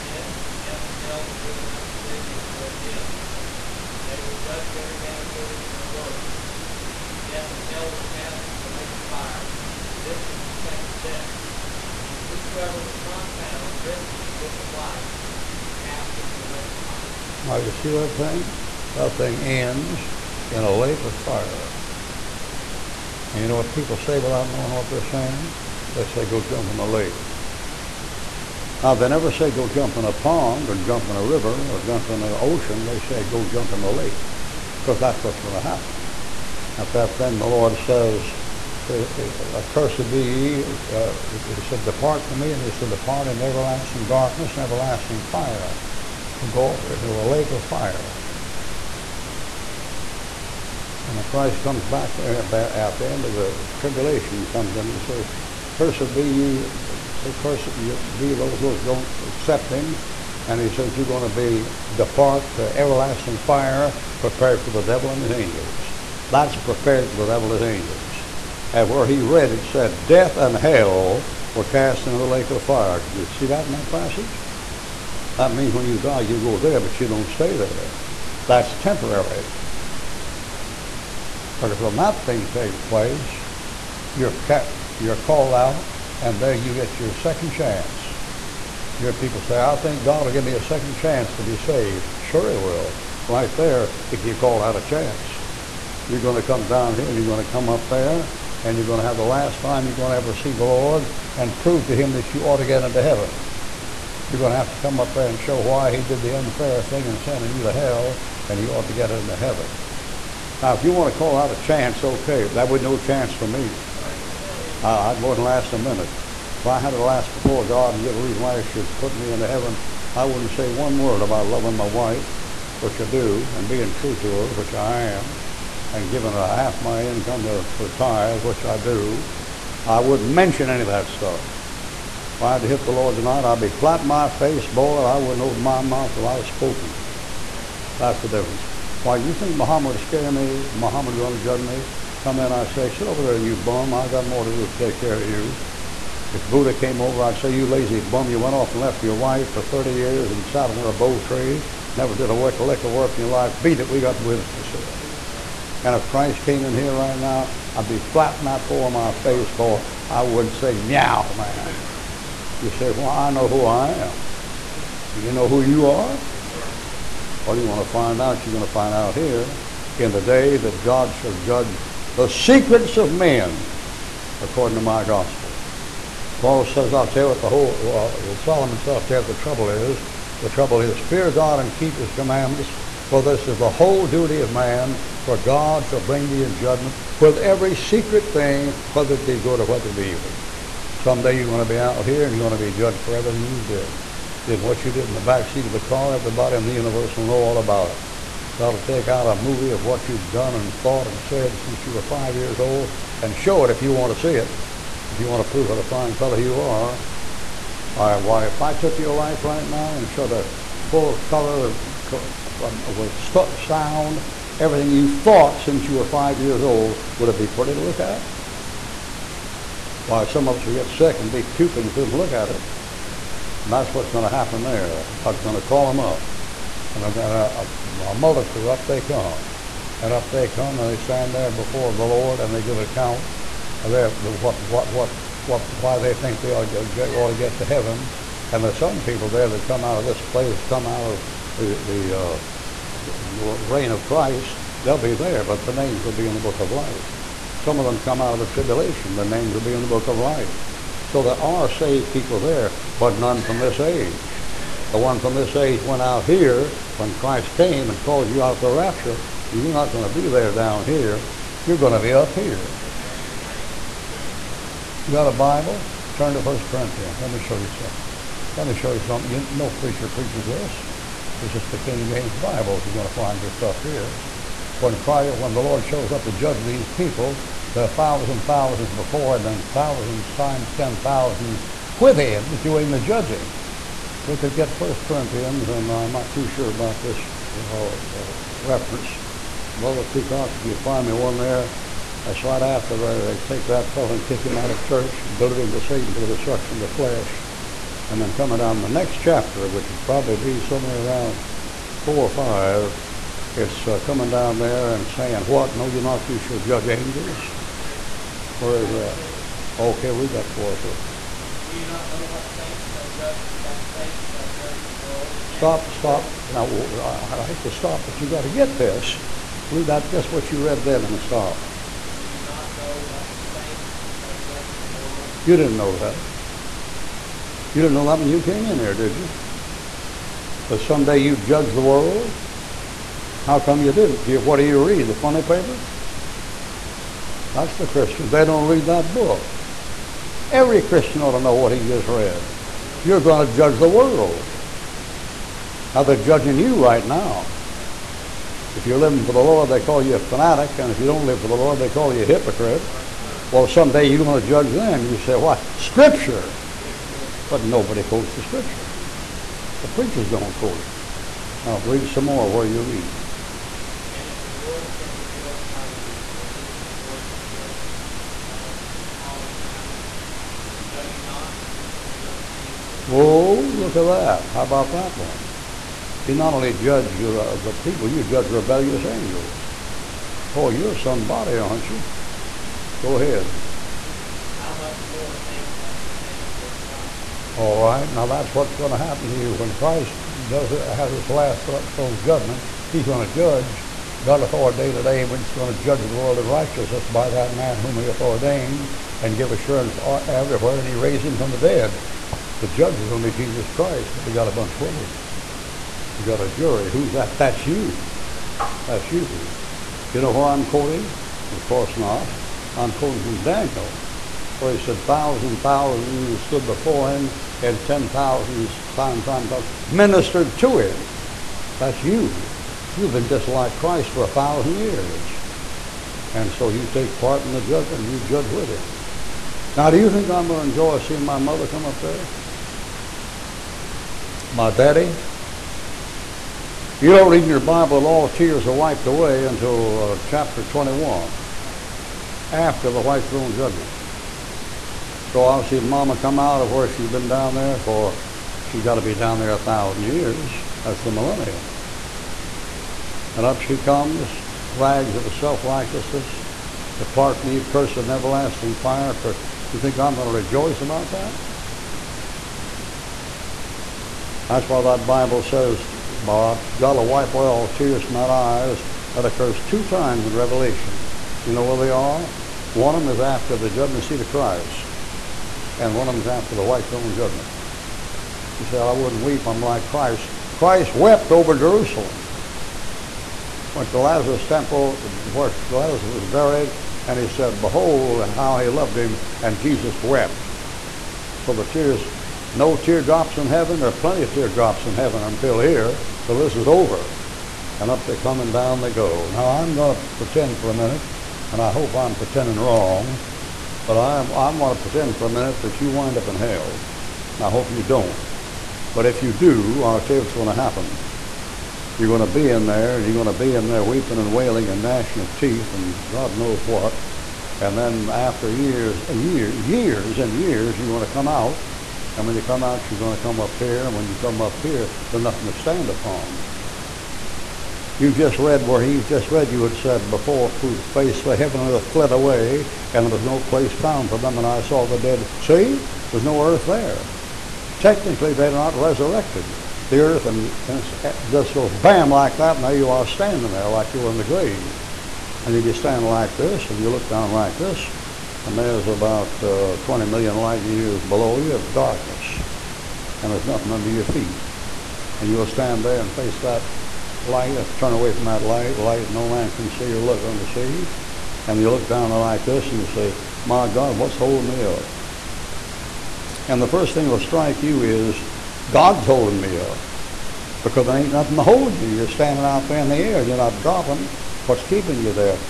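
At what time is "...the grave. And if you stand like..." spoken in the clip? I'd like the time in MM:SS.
09:04.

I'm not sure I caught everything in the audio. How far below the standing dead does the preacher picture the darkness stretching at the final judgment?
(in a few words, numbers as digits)
20 million light years.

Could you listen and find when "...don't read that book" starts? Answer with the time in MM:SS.
05:38.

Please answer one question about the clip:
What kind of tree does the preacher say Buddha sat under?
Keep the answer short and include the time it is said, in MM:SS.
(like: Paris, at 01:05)
bo tree, at 02:30.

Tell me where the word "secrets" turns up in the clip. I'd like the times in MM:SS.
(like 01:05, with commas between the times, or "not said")
02:52, 03:07.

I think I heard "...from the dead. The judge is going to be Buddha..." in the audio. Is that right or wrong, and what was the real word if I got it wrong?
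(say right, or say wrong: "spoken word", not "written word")
wrong: "Jesus", not "Buddha".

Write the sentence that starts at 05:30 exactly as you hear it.
That someday you'd judge the world?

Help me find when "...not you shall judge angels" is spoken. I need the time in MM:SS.
05:06.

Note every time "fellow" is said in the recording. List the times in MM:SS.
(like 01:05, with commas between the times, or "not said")
03:26, 04:53.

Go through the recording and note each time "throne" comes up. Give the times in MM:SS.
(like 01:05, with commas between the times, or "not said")
06:31, 07:23, 07:56.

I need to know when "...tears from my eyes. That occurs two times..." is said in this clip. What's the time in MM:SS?
07:47.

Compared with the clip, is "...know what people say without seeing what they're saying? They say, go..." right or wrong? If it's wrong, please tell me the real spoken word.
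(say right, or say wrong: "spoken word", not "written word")
wrong: "knowing", not "seeing".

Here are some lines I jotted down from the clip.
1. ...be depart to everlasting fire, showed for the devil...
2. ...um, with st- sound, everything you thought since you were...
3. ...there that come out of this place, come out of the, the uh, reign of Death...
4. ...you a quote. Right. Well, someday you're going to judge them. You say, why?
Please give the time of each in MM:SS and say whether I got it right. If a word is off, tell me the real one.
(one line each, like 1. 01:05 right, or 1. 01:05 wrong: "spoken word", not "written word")
1. 01:01 wrong: "prepared", not "showed"
2. 03:32 right
3. 03:59 wrong: "Christ", not "Death"
4. 05:52 wrong: "hypocrite", not "quote".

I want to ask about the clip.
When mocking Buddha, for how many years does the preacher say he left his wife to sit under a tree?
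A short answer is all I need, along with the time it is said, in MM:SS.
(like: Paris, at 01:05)
30, at 02:29.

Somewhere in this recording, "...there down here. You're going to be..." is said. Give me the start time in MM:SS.
04:20.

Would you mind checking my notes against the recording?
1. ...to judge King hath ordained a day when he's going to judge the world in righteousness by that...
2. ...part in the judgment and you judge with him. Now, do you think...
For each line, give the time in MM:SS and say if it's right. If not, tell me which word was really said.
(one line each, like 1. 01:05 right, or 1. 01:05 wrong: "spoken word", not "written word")
1. 06:33 wrong: "God", not "King"
2. 07:07 right.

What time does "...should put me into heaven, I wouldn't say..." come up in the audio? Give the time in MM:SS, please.
01:58.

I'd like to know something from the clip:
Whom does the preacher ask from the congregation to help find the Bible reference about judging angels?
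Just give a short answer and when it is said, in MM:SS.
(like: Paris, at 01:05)
Brother Peacock, at 04:49.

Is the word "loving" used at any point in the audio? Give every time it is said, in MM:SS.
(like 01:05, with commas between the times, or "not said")
02:01.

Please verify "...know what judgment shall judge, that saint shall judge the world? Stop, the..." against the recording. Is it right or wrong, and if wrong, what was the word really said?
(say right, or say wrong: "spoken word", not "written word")
wrong: "saint", not "judgment".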